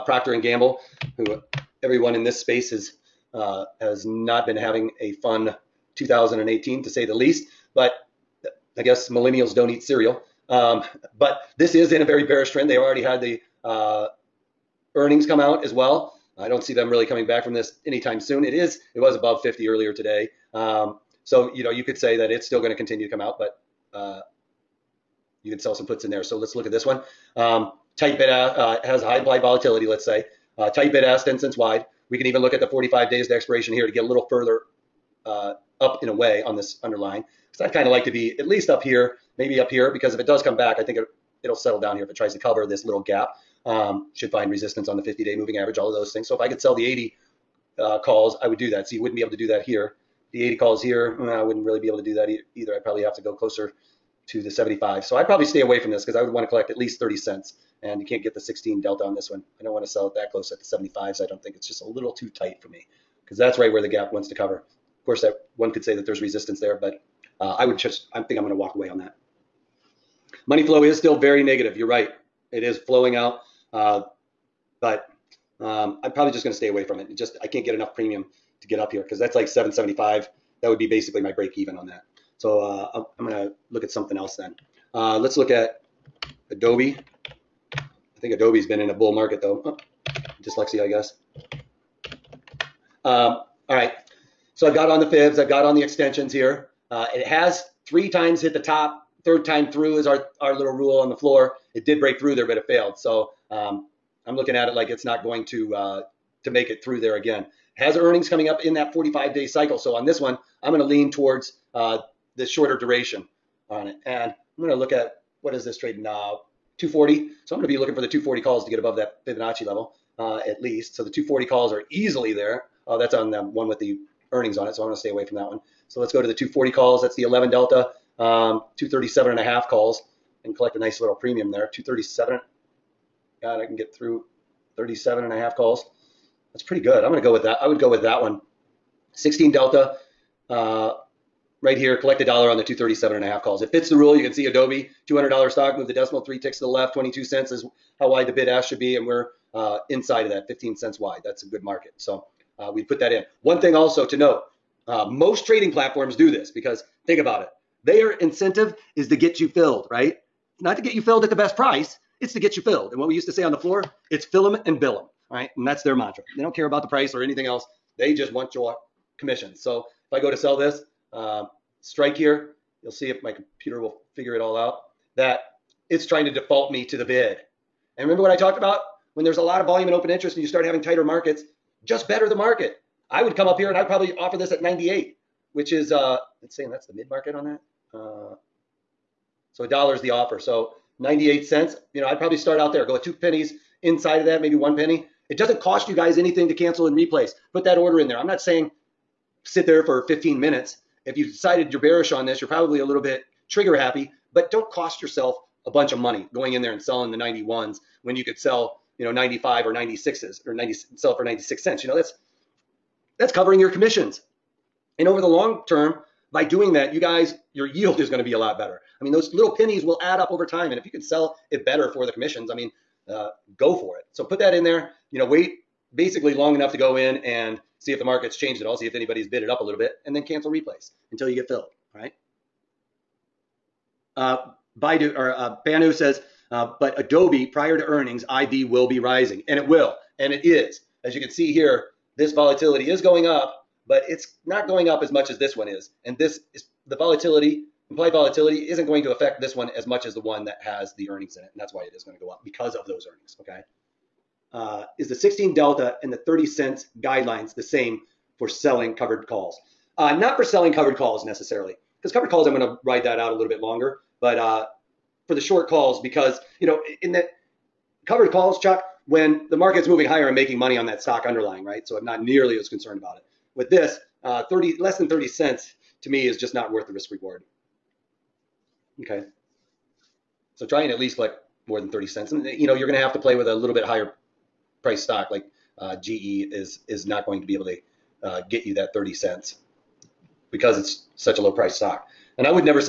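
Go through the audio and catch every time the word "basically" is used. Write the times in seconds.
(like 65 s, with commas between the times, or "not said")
80 s, 225 s.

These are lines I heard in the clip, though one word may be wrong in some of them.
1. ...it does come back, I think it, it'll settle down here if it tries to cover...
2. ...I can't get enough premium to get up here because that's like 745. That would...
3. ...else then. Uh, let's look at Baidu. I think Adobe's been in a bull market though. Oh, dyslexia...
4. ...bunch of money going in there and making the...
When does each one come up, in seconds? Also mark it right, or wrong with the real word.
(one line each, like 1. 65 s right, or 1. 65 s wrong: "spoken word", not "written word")
1. 40 s right
2. 77 s wrong: "775", not "745"
3. 84 s wrong: "Adobe", not "Baidu"
4. 205 s wrong: "selling", not "making".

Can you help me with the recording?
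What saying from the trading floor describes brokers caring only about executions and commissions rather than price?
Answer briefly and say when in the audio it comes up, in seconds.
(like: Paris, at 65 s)
fill 'em and bill 'em, at 164 s.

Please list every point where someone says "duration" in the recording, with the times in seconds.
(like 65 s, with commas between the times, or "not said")
112 s.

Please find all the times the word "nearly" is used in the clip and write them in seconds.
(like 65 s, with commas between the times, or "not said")
272 s.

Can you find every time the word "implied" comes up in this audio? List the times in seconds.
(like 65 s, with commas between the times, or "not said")
29 s, 247 s.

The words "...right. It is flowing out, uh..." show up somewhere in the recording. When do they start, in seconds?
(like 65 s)
71 s.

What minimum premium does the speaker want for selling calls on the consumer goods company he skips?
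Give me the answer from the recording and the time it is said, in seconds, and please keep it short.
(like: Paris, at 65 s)
30 cents, at 56 s.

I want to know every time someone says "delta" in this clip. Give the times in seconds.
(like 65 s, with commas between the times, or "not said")
58 s, 127 s, 139 s, 255 s.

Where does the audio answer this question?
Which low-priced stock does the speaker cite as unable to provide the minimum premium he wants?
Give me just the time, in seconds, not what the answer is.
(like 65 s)
286 s.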